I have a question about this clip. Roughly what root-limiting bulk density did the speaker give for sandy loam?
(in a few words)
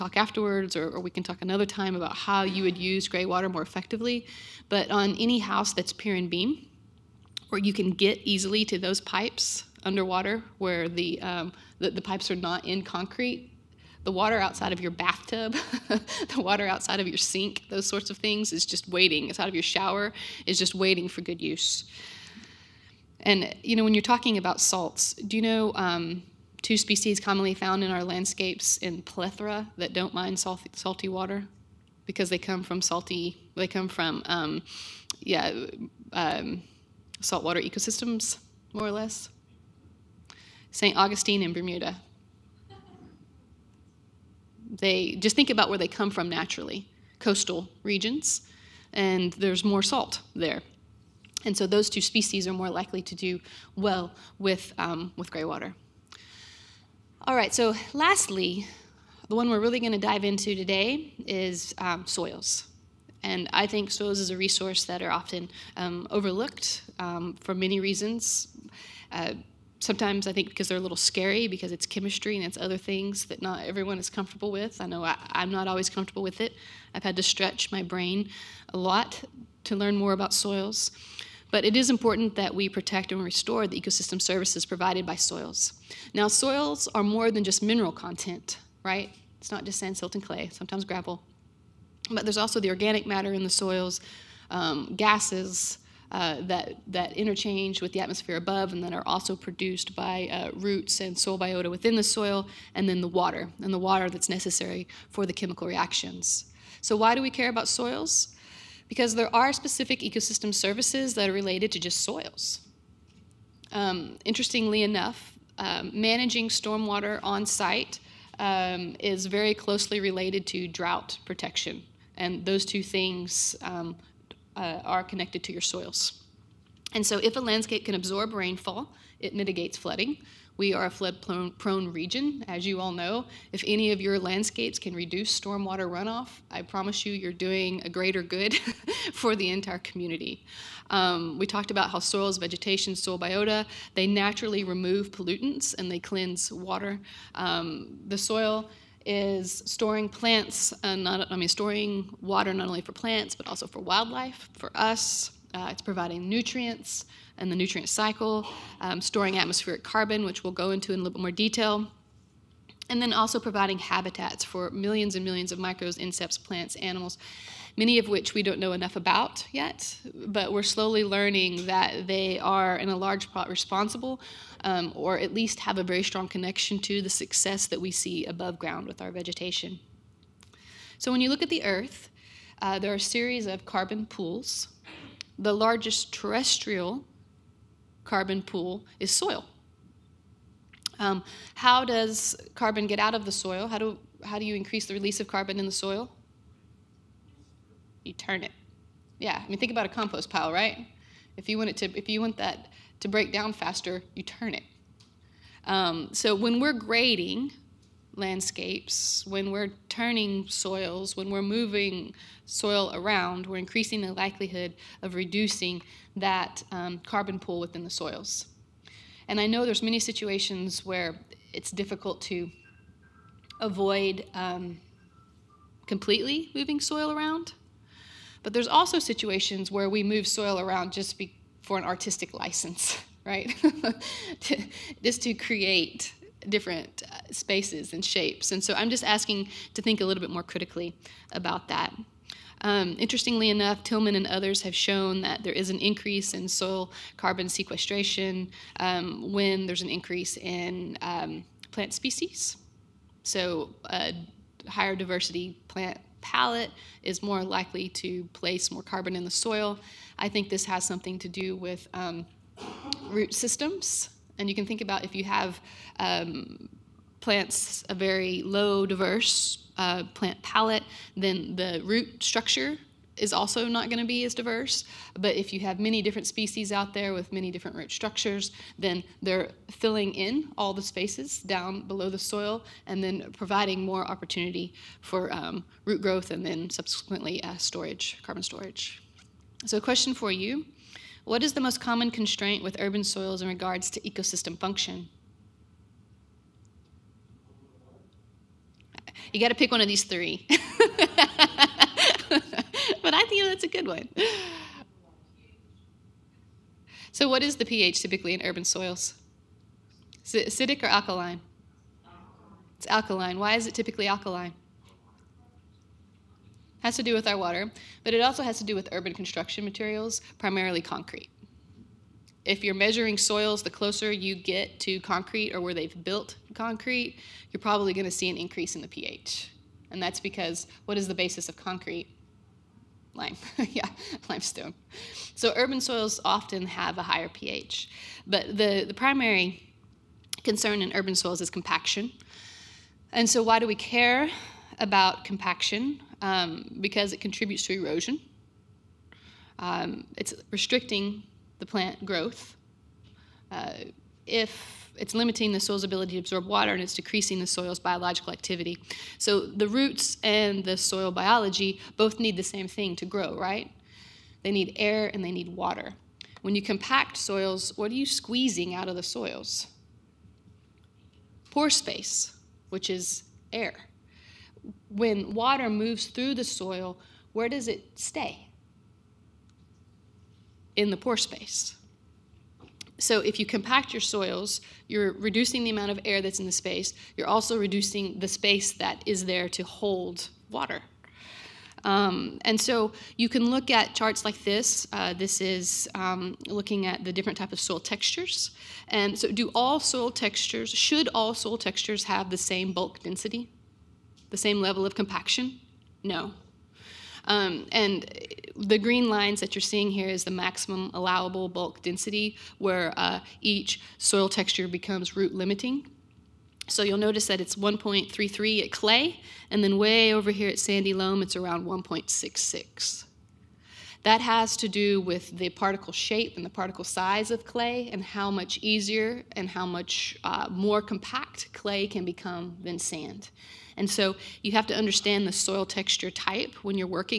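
1.66.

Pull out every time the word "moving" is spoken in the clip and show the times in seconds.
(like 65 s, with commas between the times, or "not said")
211 s, 226 s.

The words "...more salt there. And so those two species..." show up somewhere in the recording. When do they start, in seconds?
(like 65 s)
49 s.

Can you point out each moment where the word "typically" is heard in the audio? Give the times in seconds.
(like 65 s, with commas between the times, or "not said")
308 s, 313 s.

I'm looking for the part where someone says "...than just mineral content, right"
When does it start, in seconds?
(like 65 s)
87 s.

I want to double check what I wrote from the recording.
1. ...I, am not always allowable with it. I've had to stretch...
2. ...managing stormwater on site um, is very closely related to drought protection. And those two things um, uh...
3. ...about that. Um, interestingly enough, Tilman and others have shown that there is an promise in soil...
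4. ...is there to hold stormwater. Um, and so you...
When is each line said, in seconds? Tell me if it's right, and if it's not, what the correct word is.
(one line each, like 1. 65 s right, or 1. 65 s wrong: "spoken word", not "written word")
1. 75 s wrong: "comfortable", not "allowable"
2. 115 s right
3. 241 s wrong: "increase", not "promise"
4. 389 s wrong: "water", not "stormwater".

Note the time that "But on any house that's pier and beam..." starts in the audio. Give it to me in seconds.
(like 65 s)
4 s.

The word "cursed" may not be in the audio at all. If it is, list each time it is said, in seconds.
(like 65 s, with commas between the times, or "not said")
not said.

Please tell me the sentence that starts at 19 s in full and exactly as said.
It's out of your shower, is just waiting for good use.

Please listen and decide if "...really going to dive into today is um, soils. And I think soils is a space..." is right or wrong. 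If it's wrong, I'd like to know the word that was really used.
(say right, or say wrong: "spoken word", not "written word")
wrong: "resource", not "space".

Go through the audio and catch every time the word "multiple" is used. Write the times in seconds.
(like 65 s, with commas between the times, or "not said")
not said.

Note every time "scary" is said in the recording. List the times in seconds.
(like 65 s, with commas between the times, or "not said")
70 s.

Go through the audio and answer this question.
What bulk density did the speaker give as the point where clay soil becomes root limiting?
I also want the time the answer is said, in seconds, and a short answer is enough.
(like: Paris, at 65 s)
1.33, at 417 s.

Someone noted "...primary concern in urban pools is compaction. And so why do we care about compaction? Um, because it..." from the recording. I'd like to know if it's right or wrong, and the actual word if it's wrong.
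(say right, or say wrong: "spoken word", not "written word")
wrong: "soils", not "pools".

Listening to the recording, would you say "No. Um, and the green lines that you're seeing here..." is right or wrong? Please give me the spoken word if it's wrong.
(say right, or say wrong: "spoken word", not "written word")
right.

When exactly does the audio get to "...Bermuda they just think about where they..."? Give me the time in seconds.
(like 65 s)
41 s.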